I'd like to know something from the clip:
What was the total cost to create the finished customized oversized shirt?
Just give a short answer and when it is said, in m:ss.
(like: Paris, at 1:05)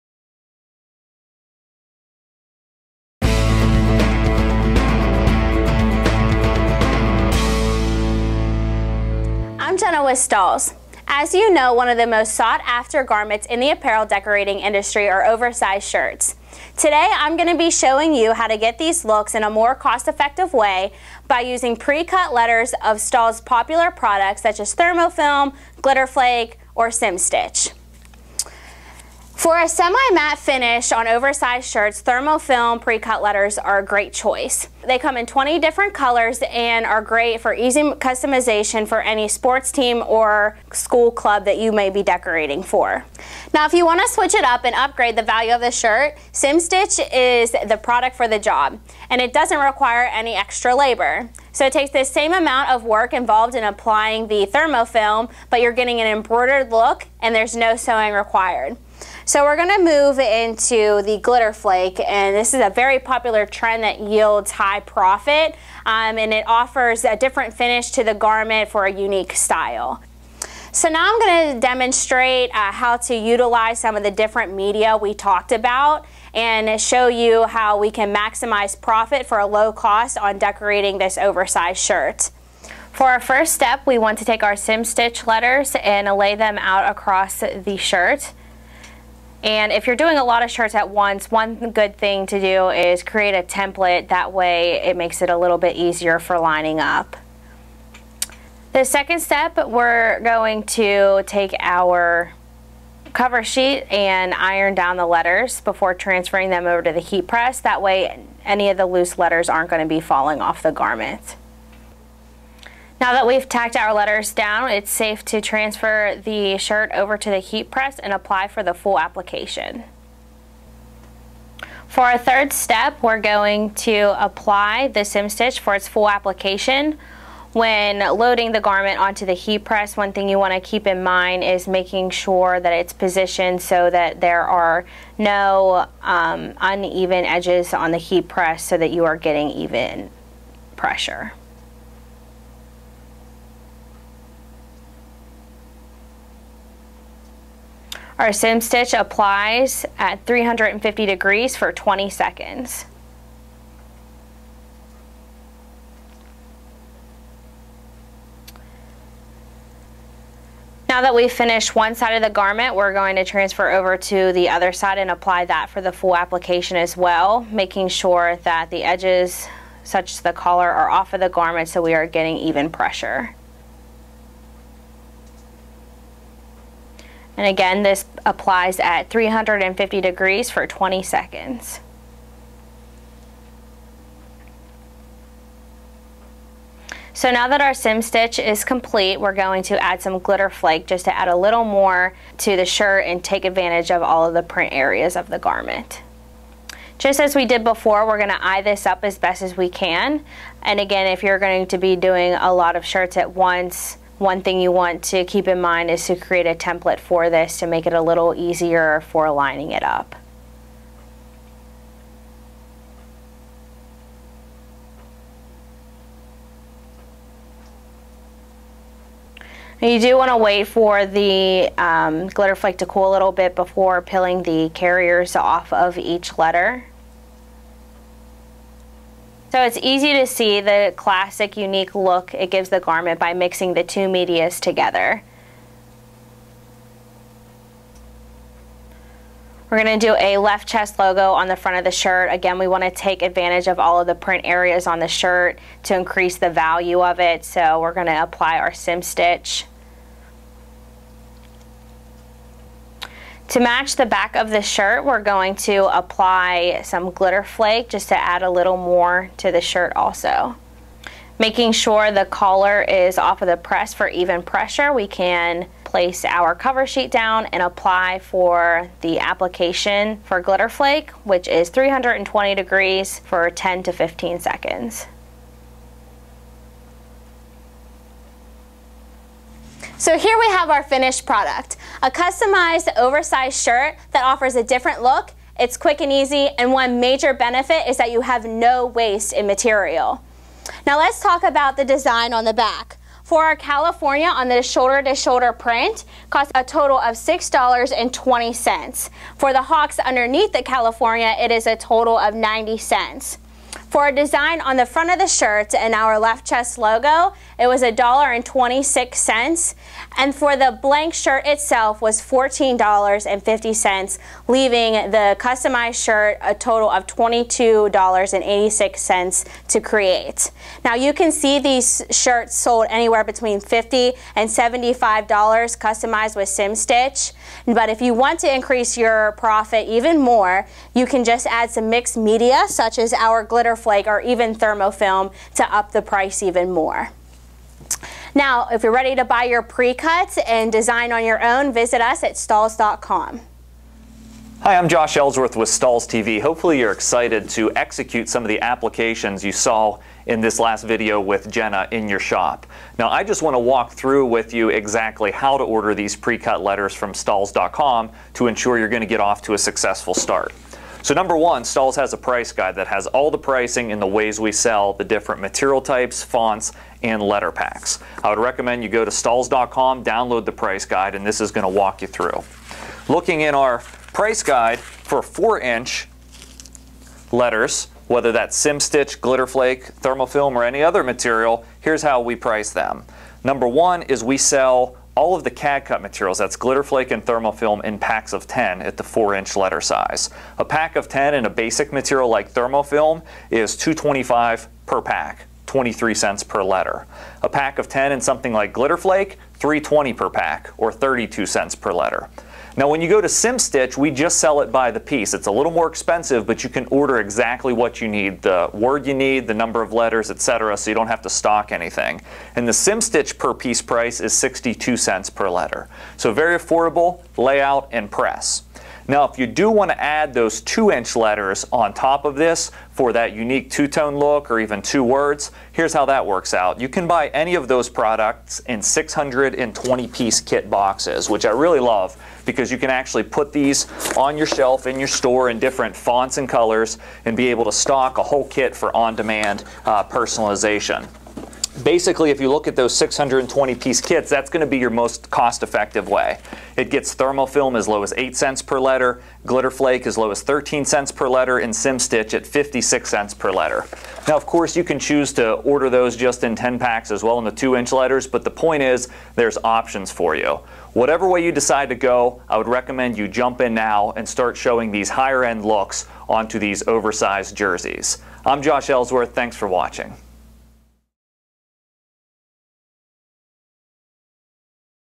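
$22.86, at 5:17.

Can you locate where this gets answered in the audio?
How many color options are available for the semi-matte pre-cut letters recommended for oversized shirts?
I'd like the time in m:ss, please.
0:35.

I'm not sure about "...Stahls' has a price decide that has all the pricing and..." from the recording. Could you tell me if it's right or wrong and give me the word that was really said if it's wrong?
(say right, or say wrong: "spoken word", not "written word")
wrong: "guide", not "decide".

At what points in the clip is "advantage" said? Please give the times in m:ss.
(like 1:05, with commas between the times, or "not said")
3:13, 4:03.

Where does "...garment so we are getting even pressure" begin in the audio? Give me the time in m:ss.
2:51.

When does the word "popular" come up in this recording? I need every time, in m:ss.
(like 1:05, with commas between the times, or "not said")
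0:23, 1:02.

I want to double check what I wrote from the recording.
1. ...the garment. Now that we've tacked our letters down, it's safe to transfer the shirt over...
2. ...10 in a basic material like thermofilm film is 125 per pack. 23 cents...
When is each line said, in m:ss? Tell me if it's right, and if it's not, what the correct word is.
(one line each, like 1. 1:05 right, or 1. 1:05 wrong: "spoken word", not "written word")
1. 1:50 right
2. 6:31 wrong: "225", not "125".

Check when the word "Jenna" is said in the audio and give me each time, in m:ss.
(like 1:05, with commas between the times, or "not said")
5:51.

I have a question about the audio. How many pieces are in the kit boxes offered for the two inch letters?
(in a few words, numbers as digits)
620.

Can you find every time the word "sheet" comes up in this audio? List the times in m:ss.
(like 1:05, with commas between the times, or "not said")
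1:43, 4:26.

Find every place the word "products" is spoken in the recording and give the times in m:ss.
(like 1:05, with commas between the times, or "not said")
0:23, 0:47, 4:41, 7:07.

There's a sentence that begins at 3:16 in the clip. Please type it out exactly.
Just as we did before, we're gonna eye this up as best as we can.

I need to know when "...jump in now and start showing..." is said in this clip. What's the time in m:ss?
7:43.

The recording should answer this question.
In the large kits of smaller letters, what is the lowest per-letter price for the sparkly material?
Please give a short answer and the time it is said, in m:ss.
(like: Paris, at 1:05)
13 cents, at 7:30.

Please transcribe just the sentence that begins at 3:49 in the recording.
So it's easy to see the classic unique look it gives the garment by mixing the two medias together.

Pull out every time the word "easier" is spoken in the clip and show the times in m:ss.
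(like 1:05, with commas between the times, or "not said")
1:35, 3:28.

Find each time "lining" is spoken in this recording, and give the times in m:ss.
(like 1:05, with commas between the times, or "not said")
1:36, 3:29.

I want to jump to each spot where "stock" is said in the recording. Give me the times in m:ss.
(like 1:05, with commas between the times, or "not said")
6:51, 7:17.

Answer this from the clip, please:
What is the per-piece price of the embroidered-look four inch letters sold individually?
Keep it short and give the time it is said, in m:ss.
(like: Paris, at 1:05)
62 cents, at 6:54.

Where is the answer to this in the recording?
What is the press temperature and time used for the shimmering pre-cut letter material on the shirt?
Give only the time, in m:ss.
4:31.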